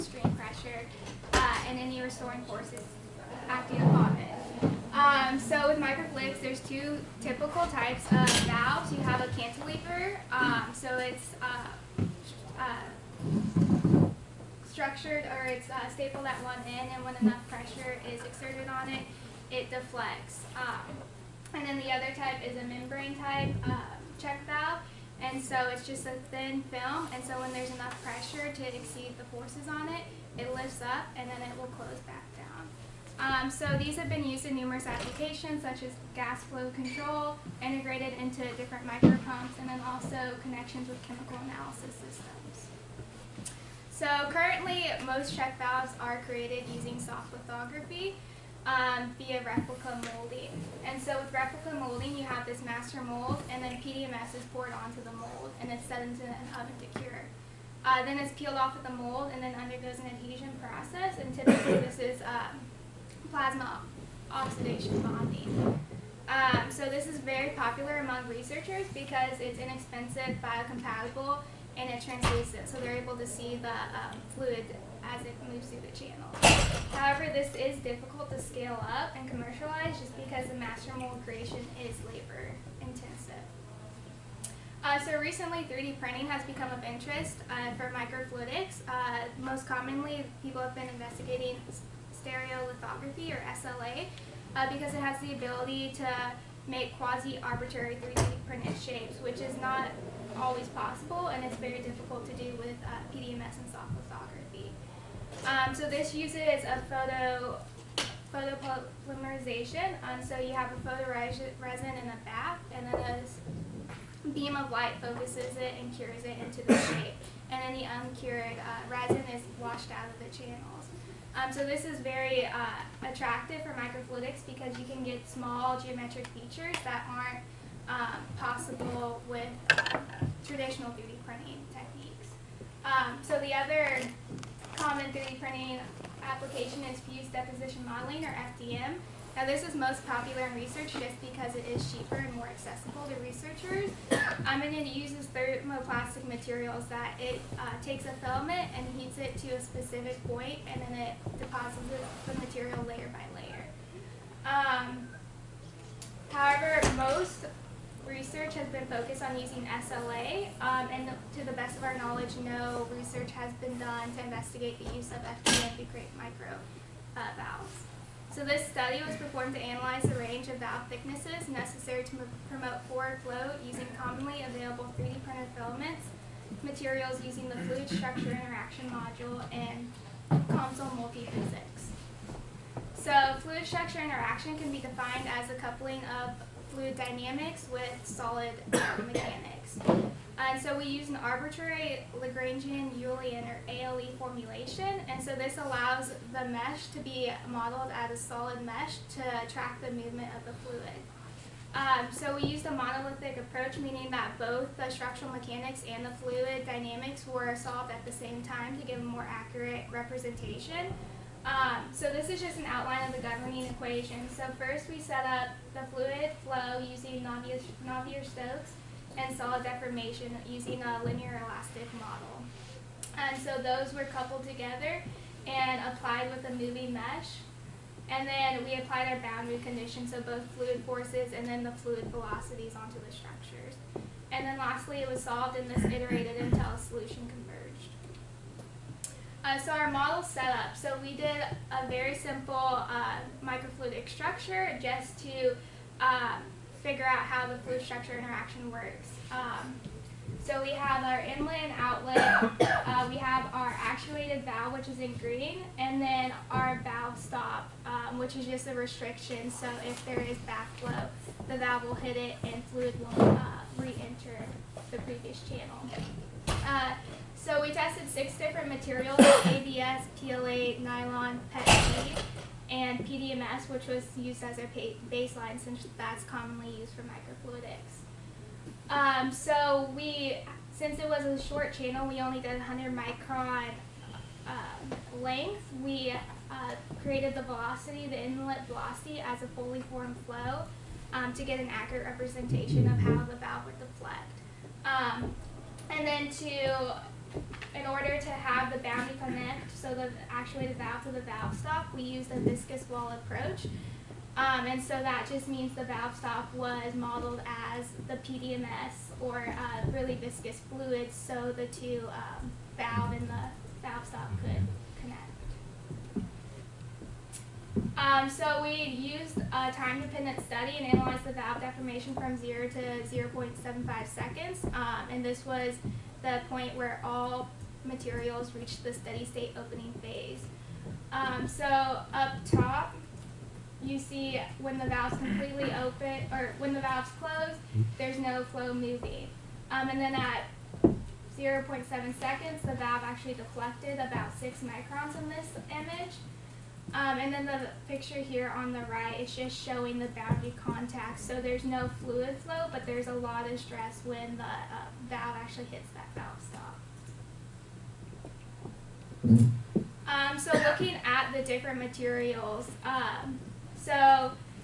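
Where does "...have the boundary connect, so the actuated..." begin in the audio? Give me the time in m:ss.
4:58.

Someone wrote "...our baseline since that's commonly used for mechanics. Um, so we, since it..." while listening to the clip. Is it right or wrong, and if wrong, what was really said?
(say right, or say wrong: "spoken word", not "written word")
wrong: "microfluidics", not "mechanics".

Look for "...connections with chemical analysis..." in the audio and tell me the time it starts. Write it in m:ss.
0:40.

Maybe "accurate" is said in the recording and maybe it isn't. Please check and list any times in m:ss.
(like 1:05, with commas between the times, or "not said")
3:29, 4:51.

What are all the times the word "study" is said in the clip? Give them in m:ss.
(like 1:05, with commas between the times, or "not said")
2:48, 5:20.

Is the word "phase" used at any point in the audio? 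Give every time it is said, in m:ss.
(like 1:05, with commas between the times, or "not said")
5:30.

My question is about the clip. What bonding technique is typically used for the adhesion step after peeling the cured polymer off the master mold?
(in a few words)
Plasma oxidation bonding.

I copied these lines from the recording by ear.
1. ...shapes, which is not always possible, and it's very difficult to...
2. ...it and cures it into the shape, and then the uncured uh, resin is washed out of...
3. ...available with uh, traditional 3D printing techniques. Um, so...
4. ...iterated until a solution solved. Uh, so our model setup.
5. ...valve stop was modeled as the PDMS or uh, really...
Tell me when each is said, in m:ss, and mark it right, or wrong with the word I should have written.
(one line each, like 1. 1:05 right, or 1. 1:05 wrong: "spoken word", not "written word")
1. 1:38 right
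2. 1:55 right
3. 2:08 wrong: "possible", not "available"
4. 3:55 wrong: "converged", not "solved"
5. 5:05 right.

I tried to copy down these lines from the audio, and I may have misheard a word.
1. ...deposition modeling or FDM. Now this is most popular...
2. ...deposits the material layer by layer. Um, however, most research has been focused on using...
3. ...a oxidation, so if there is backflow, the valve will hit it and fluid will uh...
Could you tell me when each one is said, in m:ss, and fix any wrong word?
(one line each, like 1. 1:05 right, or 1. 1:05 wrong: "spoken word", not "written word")
1. 2:17 right
2. 2:31 right
3. 4:18 wrong: "restriction", not "oxidation".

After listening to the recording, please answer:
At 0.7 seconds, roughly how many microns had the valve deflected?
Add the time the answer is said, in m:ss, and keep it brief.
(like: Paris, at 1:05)
6, at 5:44.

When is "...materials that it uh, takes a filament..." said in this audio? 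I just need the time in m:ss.
2:26.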